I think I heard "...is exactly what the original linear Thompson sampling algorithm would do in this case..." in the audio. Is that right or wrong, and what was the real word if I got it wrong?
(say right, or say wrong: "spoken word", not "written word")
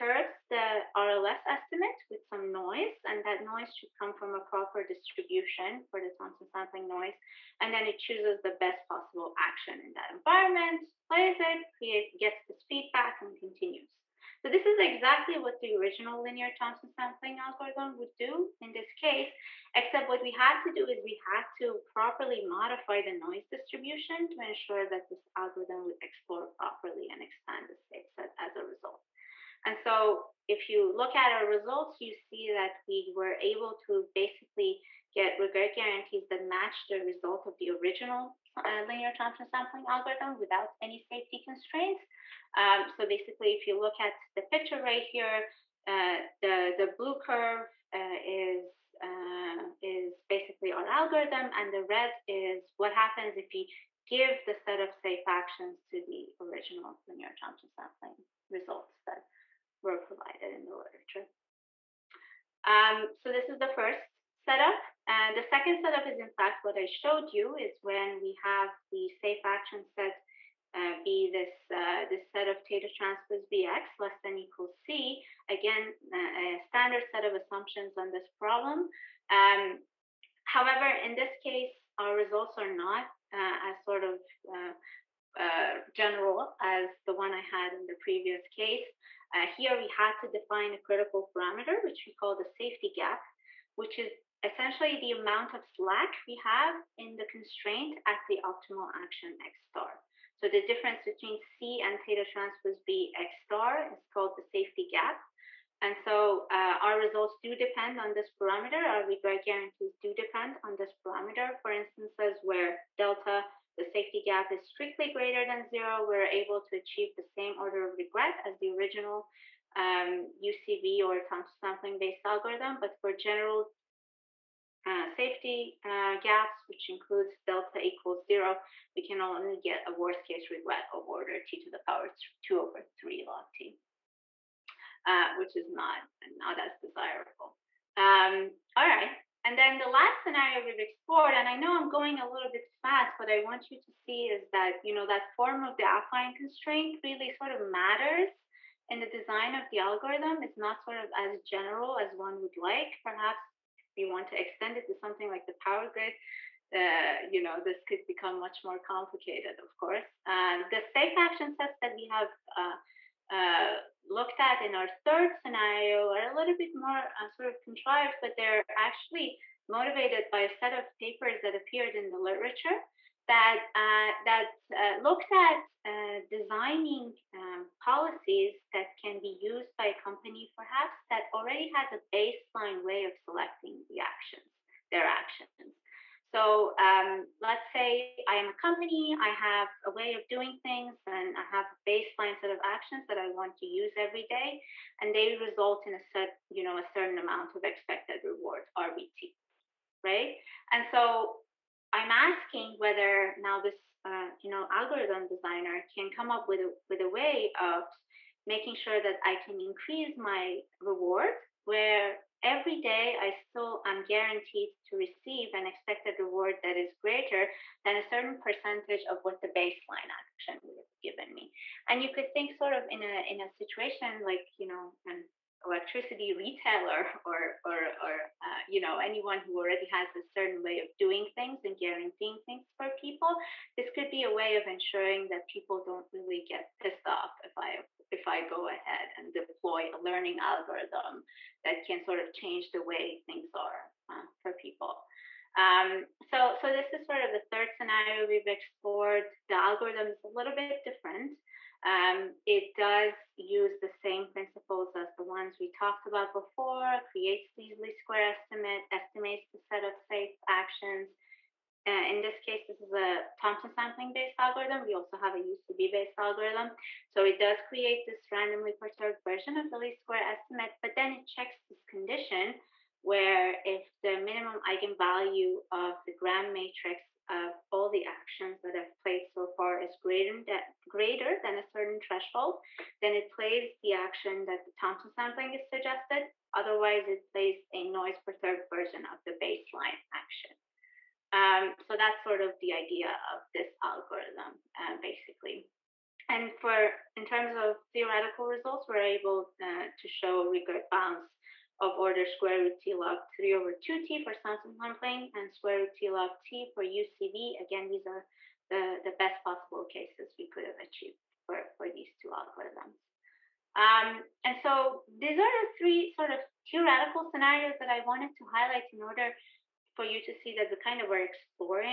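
right.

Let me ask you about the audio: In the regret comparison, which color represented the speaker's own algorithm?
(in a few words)
blue.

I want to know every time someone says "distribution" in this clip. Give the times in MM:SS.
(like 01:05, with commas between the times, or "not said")
00:04, 00:23.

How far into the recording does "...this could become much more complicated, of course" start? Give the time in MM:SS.
02:37.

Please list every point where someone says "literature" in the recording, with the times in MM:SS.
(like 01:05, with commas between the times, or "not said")
01:00, 02:52.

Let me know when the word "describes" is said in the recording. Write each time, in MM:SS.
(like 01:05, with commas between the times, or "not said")
not said.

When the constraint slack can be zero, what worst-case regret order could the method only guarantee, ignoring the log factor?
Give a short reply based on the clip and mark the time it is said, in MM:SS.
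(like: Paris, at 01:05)
t to the power 2/3, at 02:11.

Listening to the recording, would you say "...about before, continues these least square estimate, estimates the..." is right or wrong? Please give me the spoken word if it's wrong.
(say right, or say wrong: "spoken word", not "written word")
wrong: "creates", not "continues".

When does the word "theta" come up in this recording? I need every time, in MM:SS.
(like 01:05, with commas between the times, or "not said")
01:12, 01:42.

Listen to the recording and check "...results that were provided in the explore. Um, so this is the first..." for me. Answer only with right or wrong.
wrong.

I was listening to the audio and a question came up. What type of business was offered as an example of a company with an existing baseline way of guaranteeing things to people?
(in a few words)
electricity retailer.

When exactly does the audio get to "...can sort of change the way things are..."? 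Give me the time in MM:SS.
04:01.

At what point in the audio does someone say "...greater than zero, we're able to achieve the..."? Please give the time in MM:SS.
01:55.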